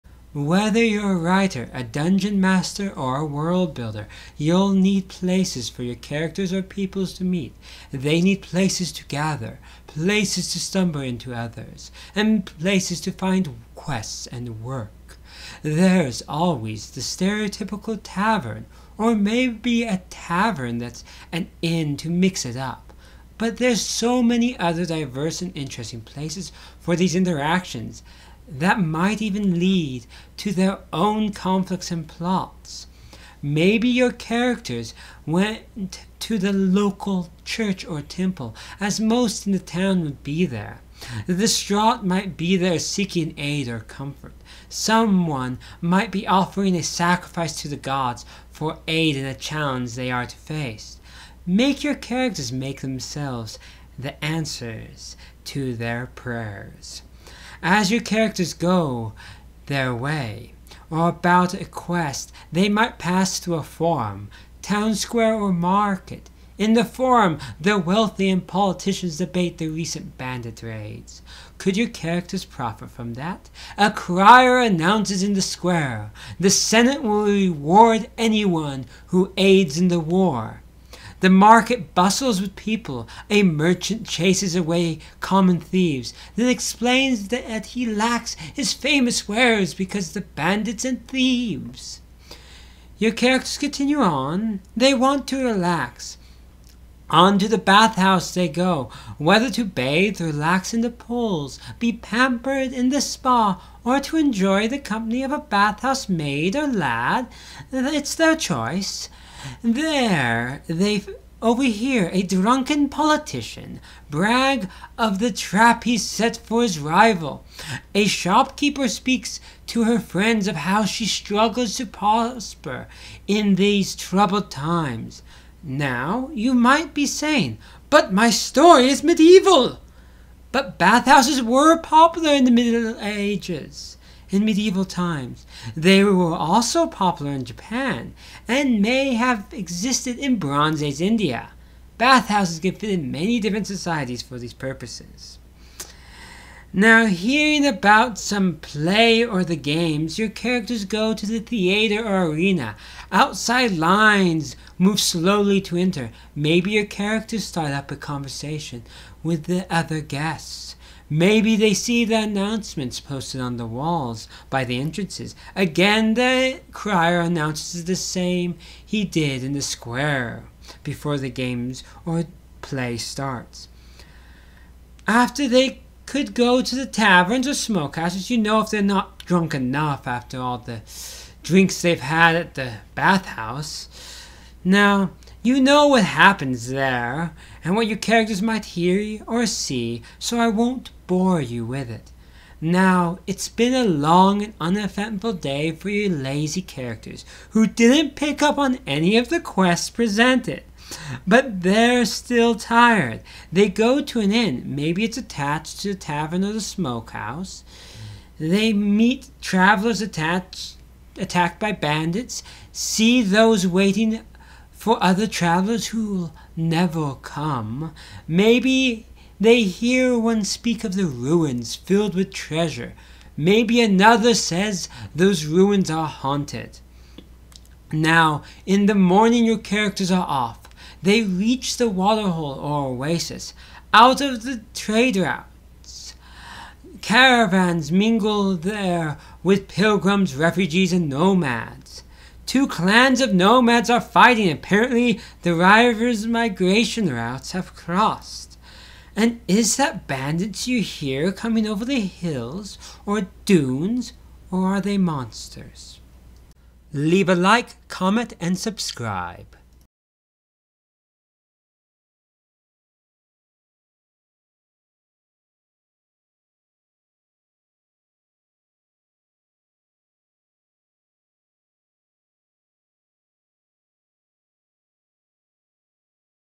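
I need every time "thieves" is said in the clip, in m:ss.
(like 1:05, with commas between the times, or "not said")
1:25, 1:31.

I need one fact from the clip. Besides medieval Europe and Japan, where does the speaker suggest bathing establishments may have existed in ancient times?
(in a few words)
Bronze Age India.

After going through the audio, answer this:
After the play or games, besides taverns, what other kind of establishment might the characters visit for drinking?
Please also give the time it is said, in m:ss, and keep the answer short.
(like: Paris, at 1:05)
Smokehouses, at 2:57.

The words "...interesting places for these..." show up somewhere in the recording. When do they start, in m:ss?
0:25.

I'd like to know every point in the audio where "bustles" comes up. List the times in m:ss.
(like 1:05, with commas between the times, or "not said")
1:21.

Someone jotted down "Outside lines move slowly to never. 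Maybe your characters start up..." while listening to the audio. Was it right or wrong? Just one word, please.
wrong.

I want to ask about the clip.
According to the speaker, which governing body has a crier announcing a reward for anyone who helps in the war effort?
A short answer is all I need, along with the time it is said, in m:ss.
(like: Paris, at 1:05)
The Senate, at 1:16.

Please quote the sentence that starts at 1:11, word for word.
Could your characters profit from that?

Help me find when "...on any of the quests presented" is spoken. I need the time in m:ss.
3:18.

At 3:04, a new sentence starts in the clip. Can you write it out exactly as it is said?
Now, you know what happens there, and what your characters might hear or see, so I won't bore you with it.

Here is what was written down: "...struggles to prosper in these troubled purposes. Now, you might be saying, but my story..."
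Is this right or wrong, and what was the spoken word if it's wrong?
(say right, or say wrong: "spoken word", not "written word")
wrong: "times", not "purposes".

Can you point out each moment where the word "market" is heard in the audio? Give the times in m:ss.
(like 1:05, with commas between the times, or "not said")
1:05, 1:21.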